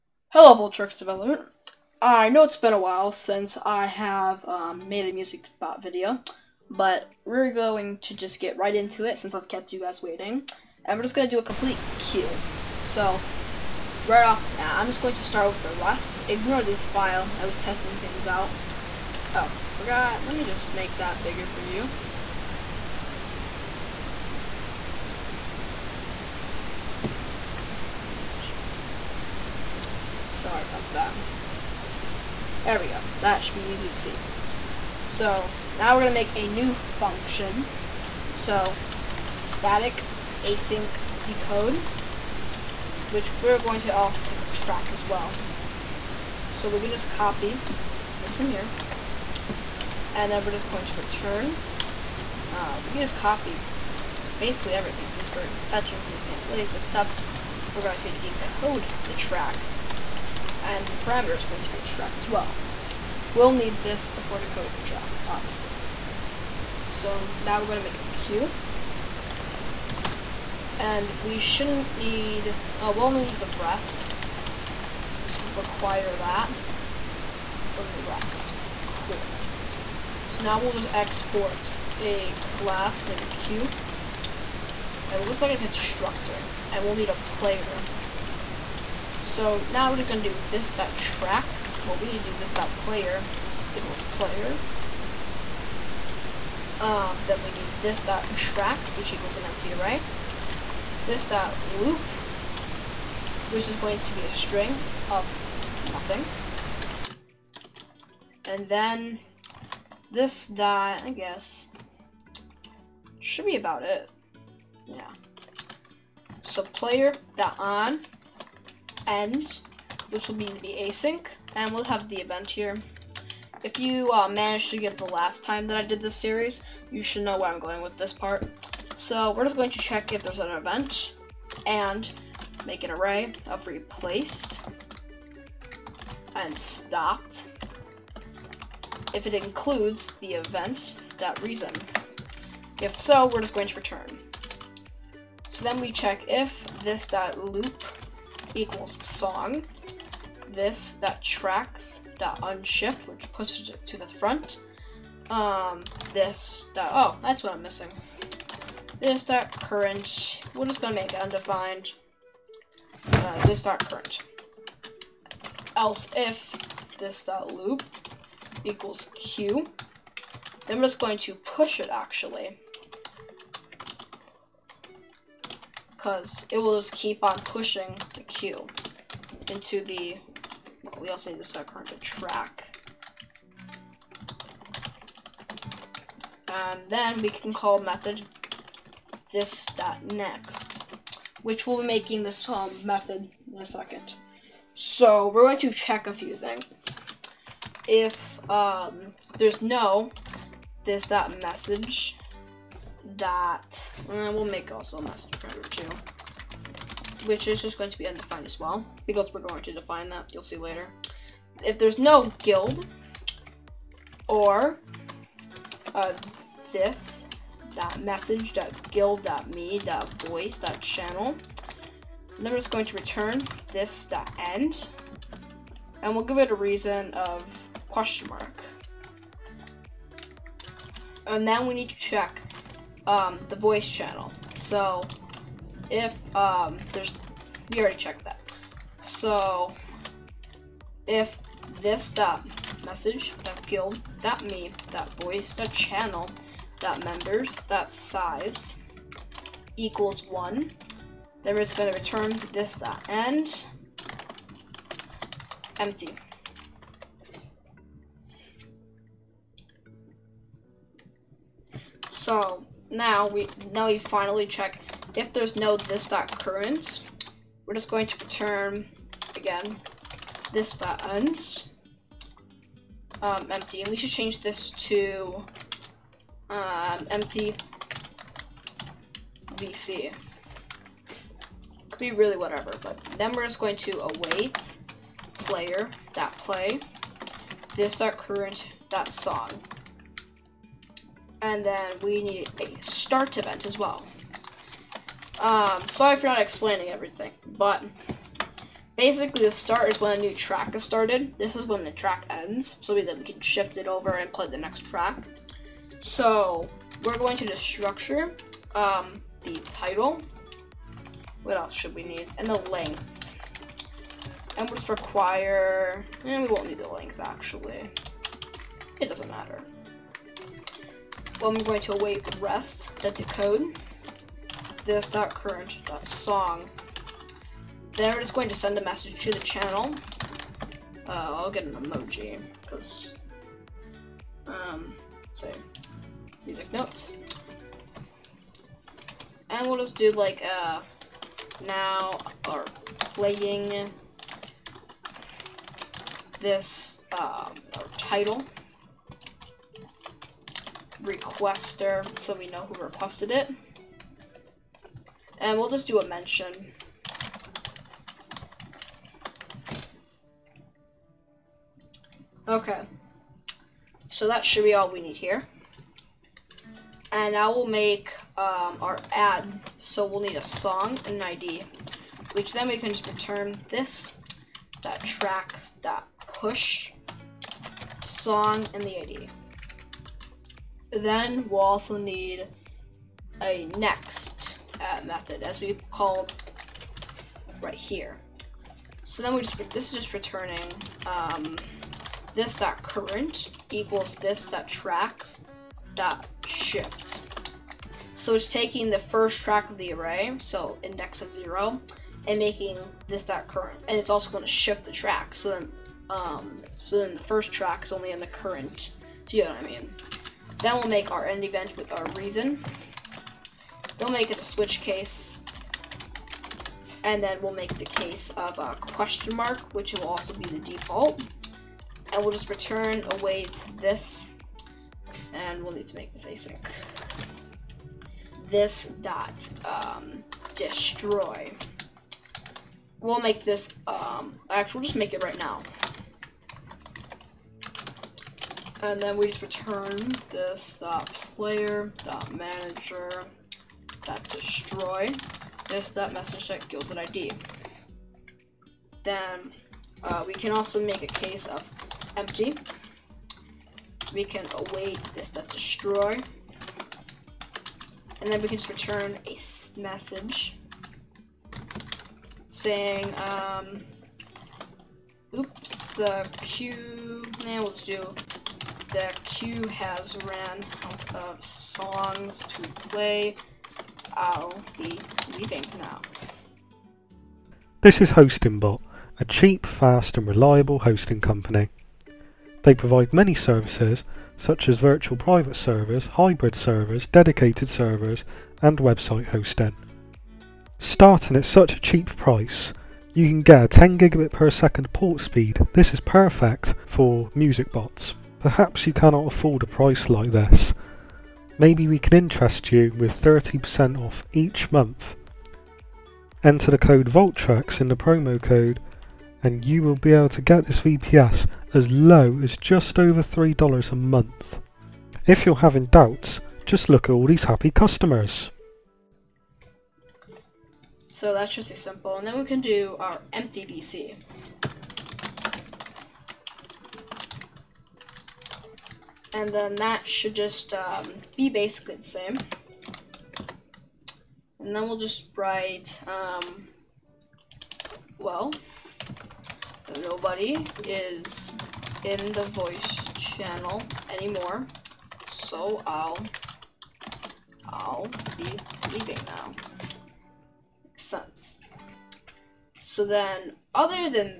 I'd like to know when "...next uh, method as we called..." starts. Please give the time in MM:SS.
06:23.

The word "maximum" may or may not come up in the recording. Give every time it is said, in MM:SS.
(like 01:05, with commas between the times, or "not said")
not said.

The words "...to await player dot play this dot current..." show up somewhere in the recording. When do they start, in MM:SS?
04:43.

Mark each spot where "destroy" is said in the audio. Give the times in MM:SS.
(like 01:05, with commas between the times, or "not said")
07:10, 07:24, 07:35.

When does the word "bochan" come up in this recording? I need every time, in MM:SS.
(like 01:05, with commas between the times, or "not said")
not said.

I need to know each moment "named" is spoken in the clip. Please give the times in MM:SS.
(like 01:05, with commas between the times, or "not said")
01:23.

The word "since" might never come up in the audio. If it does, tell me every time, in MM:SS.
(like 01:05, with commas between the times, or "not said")
00:03, 00:09, 00:55.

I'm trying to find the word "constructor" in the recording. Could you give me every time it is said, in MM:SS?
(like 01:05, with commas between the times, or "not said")
01:25.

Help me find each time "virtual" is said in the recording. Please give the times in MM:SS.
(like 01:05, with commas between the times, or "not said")
08:04.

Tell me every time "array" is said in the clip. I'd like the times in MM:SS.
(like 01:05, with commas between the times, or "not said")
01:39, 02:12, 06:39.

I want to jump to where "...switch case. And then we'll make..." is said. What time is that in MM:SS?
06:54.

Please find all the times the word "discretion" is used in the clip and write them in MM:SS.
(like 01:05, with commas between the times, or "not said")
not said.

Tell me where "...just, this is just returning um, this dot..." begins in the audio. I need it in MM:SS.
06:29.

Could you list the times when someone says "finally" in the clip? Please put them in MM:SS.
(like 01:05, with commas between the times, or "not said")
04:23.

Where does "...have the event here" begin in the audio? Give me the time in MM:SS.
02:01.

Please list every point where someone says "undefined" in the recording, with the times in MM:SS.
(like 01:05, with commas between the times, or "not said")
02:41, 03:28.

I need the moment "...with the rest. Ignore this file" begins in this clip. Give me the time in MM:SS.
00:15.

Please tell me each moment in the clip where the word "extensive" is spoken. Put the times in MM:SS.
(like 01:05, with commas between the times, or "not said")
not said.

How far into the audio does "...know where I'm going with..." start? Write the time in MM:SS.
02:07.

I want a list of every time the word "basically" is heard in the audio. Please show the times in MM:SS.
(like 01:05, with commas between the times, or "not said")
00:54, 04:58, 08:51.